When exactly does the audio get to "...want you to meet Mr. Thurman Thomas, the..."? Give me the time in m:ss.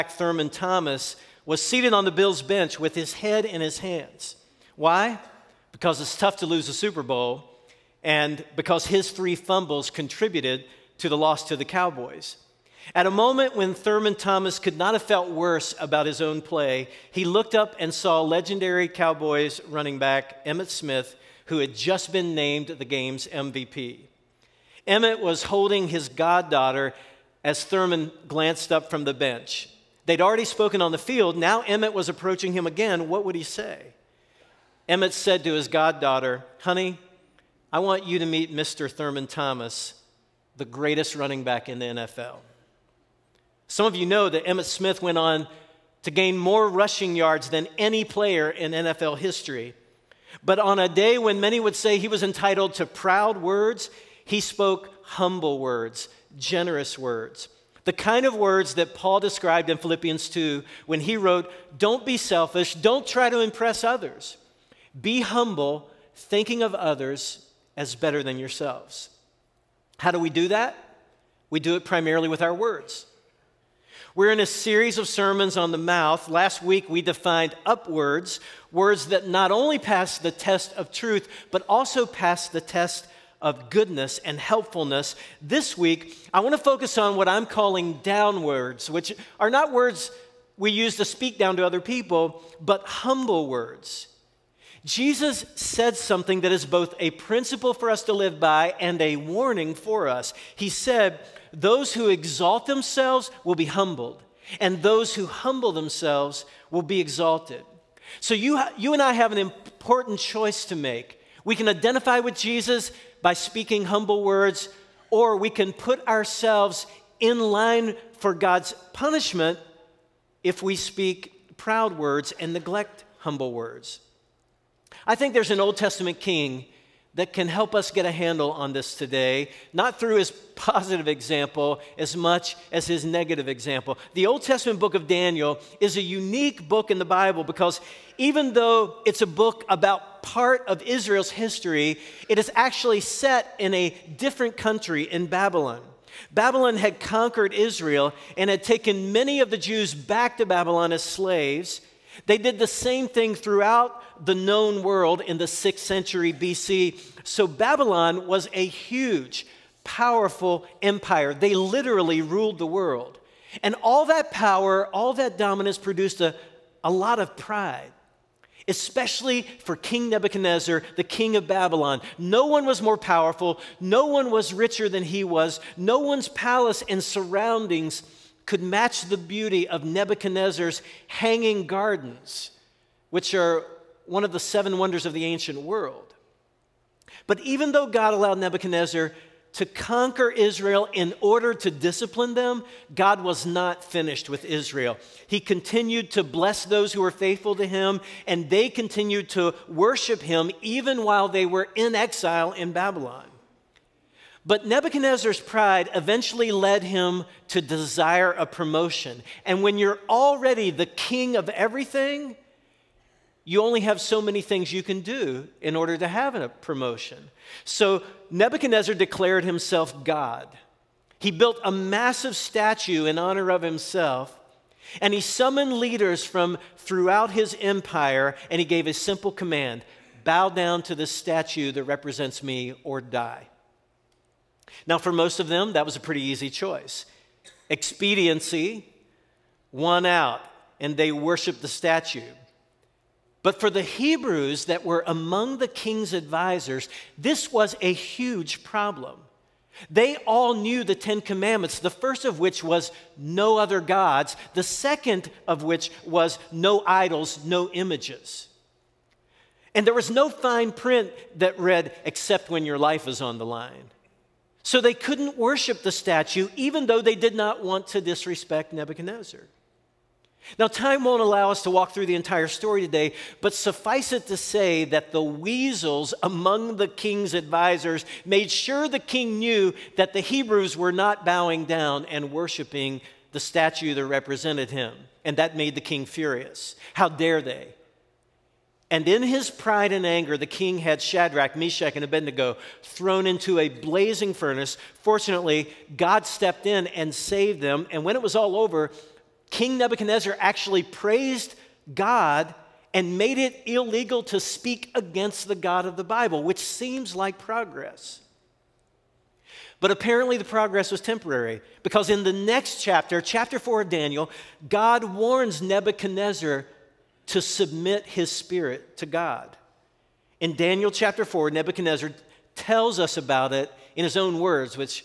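0:37.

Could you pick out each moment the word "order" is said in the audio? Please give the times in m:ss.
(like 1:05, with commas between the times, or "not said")
3:11, 3:35.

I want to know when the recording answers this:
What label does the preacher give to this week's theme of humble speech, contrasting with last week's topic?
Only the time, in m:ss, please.
1:27.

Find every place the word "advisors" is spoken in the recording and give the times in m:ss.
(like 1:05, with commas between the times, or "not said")
4:06, 4:37.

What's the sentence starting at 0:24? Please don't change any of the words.
Emmitt was holding his goddaughter as Thurman glanced up from the bench.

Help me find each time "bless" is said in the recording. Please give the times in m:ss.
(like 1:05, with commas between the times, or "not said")
3:16.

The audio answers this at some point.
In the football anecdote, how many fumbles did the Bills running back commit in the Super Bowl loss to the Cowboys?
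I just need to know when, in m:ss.
0:09.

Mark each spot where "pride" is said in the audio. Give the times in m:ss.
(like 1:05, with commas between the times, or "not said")
2:47, 3:25, 4:49.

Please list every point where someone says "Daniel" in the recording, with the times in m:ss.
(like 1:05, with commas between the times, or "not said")
2:15, 5:13, 5:20.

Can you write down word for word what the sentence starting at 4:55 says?
Fortunately, God stepped in and saved them.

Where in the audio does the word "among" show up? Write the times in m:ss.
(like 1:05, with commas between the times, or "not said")
4:05, 4:36.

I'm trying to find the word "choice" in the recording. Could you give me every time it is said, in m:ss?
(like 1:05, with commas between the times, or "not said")
1:50, 3:56.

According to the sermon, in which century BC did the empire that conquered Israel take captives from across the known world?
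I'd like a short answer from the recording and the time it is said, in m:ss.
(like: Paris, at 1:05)
6th century BC, at 2:35.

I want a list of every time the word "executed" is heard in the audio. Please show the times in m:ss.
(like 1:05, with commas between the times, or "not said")
not said.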